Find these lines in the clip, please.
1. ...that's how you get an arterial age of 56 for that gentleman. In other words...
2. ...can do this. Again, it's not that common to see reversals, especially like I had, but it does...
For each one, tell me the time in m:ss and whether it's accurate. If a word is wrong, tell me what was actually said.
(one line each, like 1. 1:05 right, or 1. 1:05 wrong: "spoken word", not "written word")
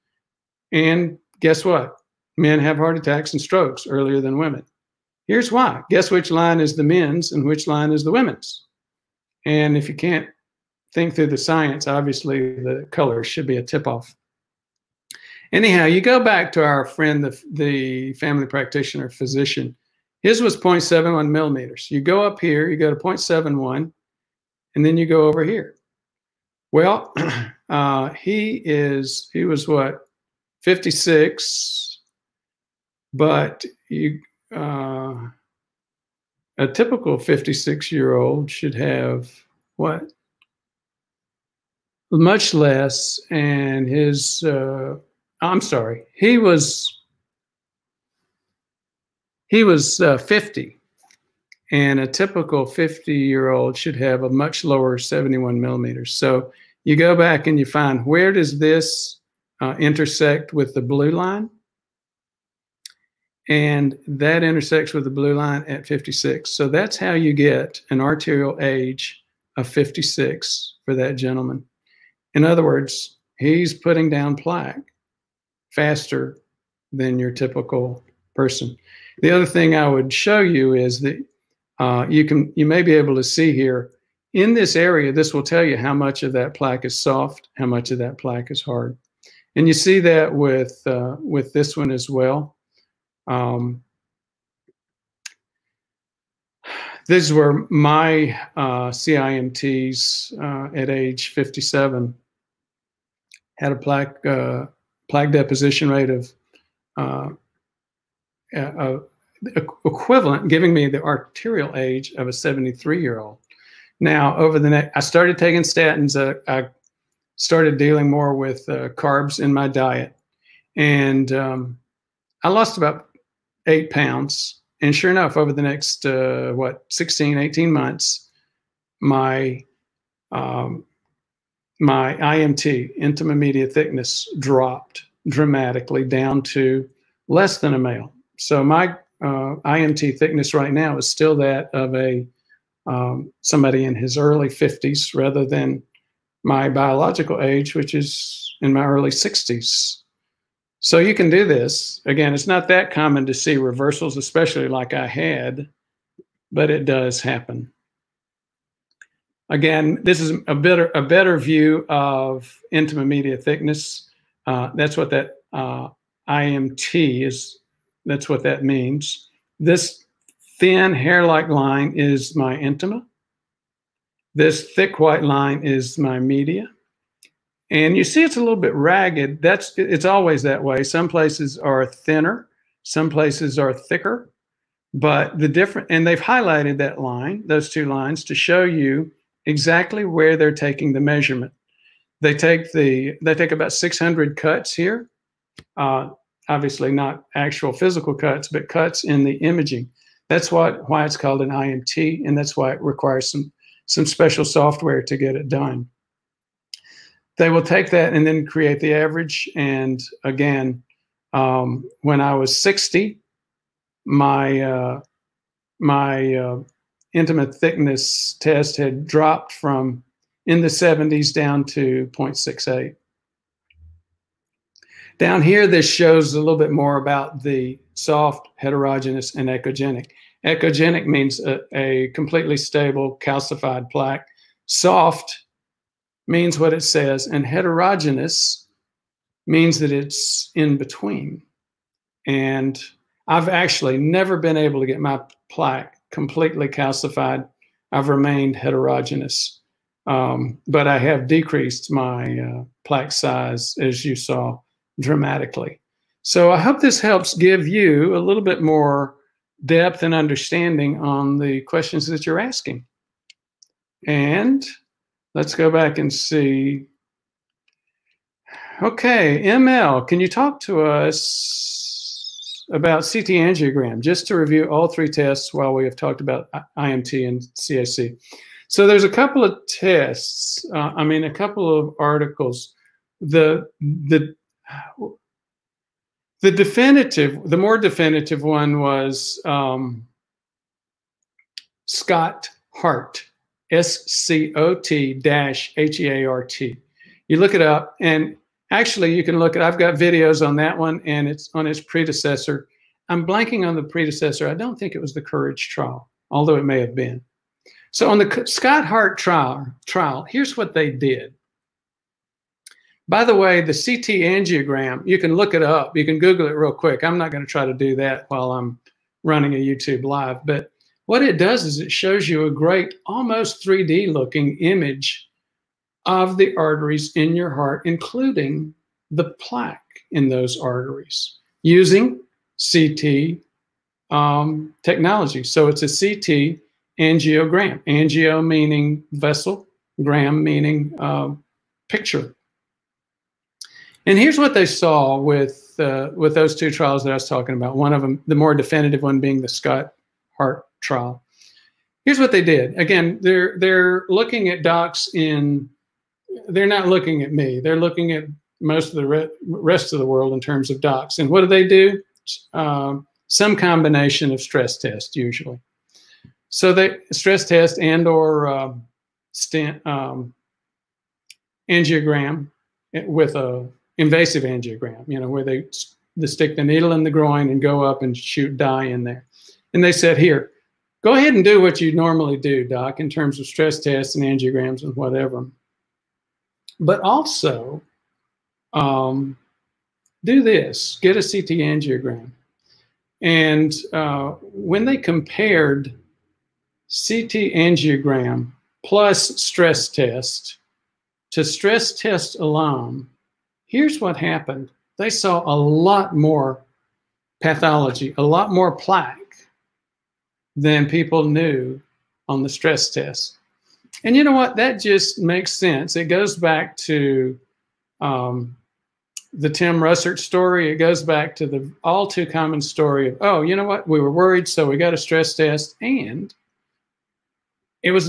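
1. 1:06 right
2. 2:31 right.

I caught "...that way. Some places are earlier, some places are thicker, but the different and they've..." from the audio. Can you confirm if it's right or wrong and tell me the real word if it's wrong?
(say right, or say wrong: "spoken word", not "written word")
wrong: "thinner", not "earlier".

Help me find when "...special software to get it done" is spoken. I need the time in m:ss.
3:24.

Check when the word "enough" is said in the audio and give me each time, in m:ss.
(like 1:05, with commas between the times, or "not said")
2:05.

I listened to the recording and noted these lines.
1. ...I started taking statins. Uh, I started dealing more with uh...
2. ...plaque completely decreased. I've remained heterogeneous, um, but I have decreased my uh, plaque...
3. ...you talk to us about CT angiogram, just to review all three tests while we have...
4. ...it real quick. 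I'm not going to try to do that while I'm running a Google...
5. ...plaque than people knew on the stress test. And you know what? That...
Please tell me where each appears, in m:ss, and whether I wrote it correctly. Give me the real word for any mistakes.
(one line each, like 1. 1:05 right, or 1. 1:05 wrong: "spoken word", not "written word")
1. 1:54 right
2. 4:05 wrong: "calcified", not "decreased"
3. 4:30 right
4. 5:16 wrong: "YouTube", not "Google"
5. 6:48 right.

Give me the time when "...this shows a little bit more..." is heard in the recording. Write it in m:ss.
3:45.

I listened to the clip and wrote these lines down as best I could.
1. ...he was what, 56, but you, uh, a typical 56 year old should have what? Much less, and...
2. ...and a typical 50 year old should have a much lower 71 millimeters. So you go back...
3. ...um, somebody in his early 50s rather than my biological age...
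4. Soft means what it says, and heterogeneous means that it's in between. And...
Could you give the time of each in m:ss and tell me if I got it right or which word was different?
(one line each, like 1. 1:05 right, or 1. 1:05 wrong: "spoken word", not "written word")
1. 0:29 right
2. 0:51 right
3. 2:22 right
4. 3:54 right.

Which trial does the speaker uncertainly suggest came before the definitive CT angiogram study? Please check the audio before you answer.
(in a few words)
Courage trial.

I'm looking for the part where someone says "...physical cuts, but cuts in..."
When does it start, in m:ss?
3:17.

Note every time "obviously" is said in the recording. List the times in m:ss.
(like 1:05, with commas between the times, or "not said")
0:11, 3:16.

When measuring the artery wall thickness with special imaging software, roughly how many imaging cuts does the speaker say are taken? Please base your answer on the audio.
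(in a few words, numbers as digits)
about 600.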